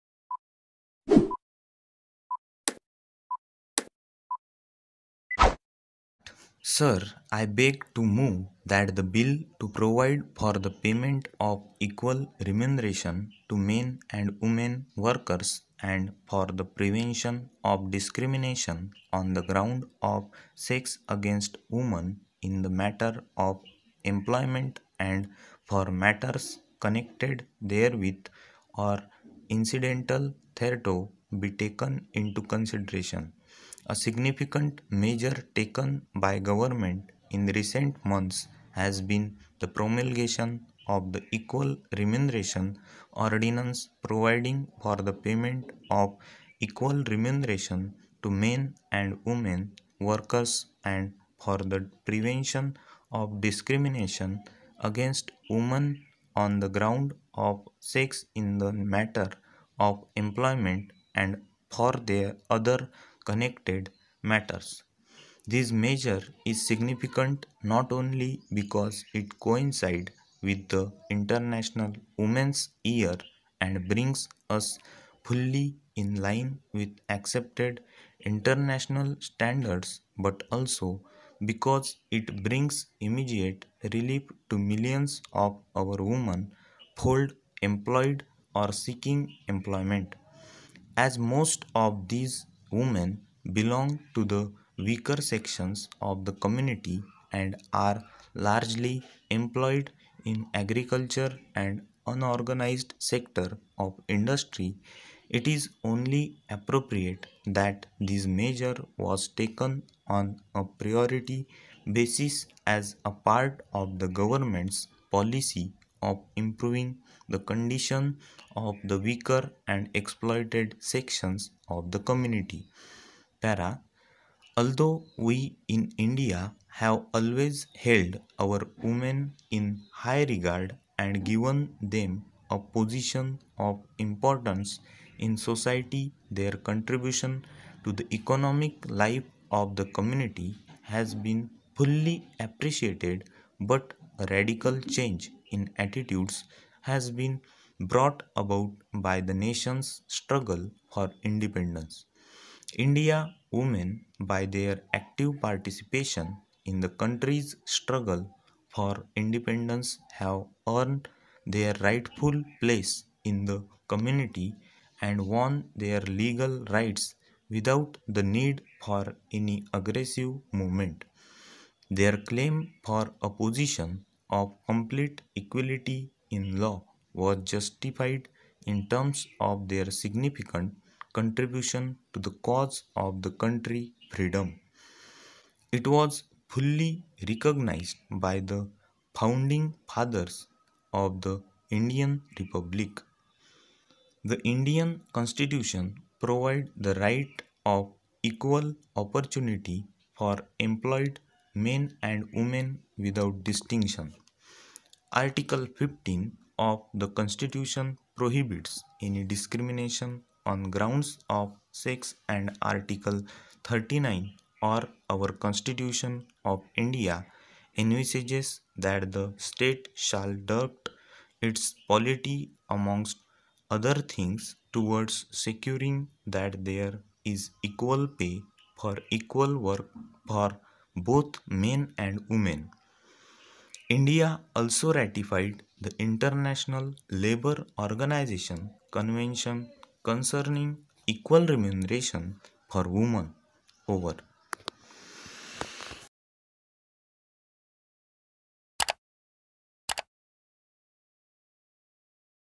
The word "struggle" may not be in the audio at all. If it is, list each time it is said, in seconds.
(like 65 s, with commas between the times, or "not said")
150 s, 157 s.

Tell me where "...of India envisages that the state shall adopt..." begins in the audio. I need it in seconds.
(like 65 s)
216 s.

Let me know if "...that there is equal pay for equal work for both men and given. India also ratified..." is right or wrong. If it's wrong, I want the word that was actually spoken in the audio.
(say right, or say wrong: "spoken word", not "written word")
wrong: "women", not "given".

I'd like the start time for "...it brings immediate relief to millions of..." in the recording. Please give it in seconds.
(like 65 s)
82 s.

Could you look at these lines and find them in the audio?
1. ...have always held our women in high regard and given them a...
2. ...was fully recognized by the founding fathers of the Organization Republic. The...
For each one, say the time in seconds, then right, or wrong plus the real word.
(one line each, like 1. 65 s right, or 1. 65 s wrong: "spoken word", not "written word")
1. 126 s right
2. 185 s wrong: "Indian", not "Organization".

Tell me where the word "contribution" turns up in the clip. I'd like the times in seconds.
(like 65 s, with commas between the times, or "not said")
136 s, 181 s.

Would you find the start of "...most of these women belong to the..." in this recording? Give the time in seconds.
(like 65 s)
91 s.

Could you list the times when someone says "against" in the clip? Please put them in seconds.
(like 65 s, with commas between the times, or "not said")
21 s, 54 s.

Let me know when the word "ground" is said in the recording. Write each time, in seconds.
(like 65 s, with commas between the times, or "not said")
19 s, 56 s, 210 s.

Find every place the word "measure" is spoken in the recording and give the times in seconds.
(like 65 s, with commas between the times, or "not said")
35 s, 65 s, 108 s.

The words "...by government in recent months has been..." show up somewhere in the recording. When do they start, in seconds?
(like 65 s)
36 s.